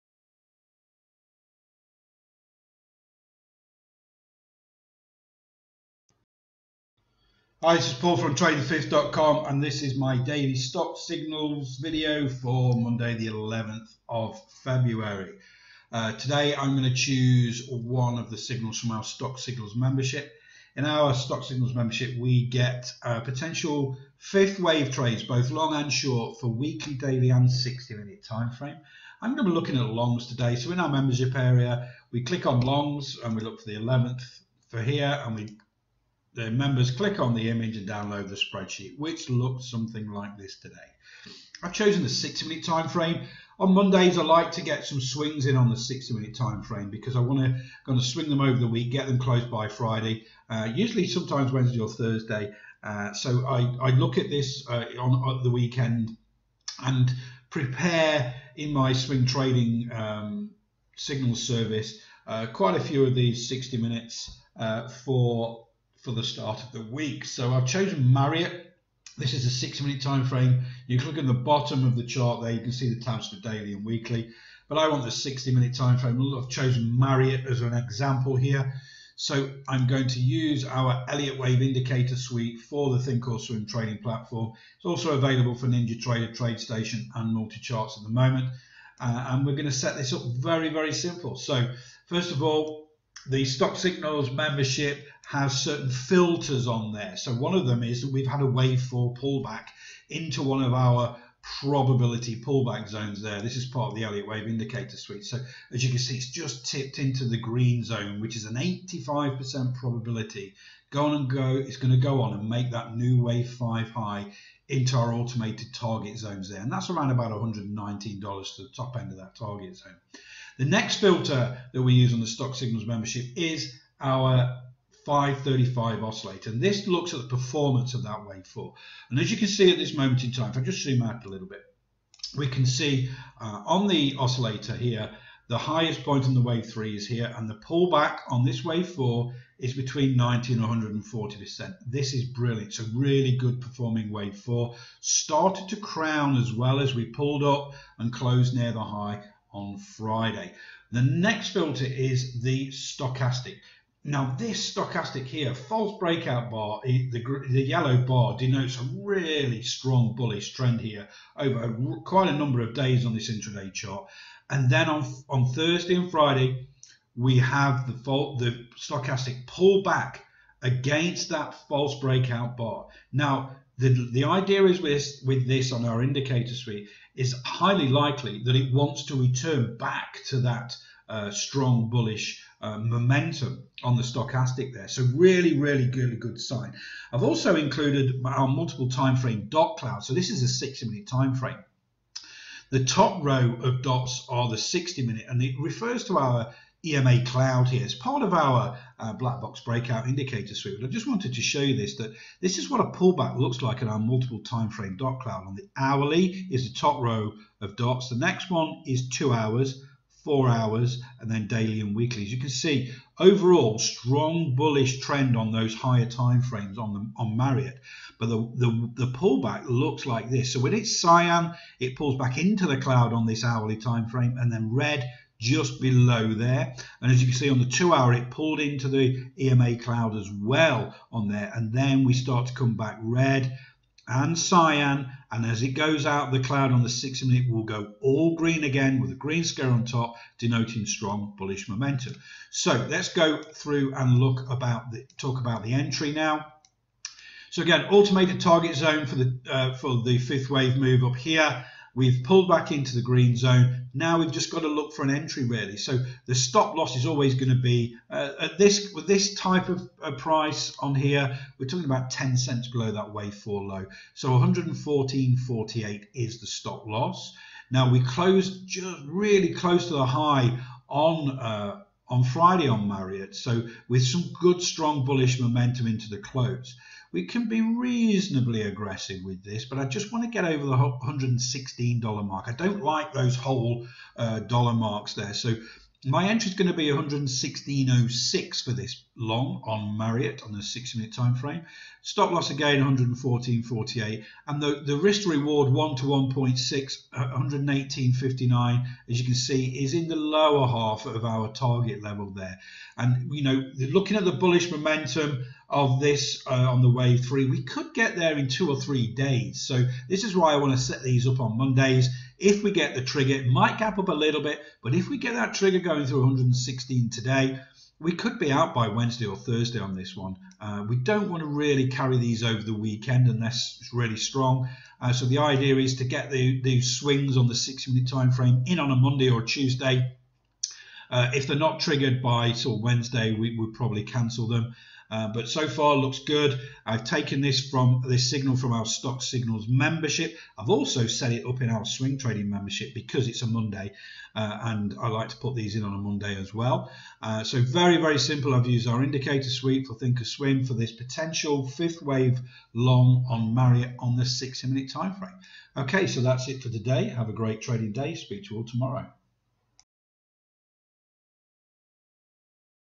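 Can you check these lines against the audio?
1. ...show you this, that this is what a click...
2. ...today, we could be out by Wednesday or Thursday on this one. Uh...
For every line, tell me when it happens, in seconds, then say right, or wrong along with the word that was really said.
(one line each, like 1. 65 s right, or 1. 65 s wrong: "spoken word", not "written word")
1. 201 s wrong: "pullback", not "click"
2. 317 s right.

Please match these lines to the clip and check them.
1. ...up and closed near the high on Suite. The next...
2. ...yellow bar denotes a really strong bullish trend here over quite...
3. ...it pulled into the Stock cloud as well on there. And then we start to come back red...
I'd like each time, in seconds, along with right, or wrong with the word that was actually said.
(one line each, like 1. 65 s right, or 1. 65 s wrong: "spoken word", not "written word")
1. 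147 s wrong: "Friday", not "Suite"
2. 157 s right
3. 228 s wrong: "EMA", not "Stock".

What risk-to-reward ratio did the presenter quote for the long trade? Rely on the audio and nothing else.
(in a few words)
1 to 1.6.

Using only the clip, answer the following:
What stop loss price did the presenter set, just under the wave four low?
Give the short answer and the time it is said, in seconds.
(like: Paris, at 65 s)
114.48, at 264 s.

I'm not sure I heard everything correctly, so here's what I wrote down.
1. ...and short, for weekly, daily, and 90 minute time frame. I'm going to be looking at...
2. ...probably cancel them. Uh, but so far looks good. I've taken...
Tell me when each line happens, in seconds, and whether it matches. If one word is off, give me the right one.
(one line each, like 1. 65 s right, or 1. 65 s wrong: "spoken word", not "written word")
1. 25 s wrong: "60", not "90"
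2. 333 s right.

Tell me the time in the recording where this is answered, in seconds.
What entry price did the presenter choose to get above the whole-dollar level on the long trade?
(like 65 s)
286 s.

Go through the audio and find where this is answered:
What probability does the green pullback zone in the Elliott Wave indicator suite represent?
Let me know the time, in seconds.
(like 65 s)
108 s.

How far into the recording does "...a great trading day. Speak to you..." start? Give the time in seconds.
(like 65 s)
357 s.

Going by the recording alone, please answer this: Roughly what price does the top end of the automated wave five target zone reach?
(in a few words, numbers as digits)
$119.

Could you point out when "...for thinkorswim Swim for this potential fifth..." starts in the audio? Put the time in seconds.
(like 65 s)
349 s.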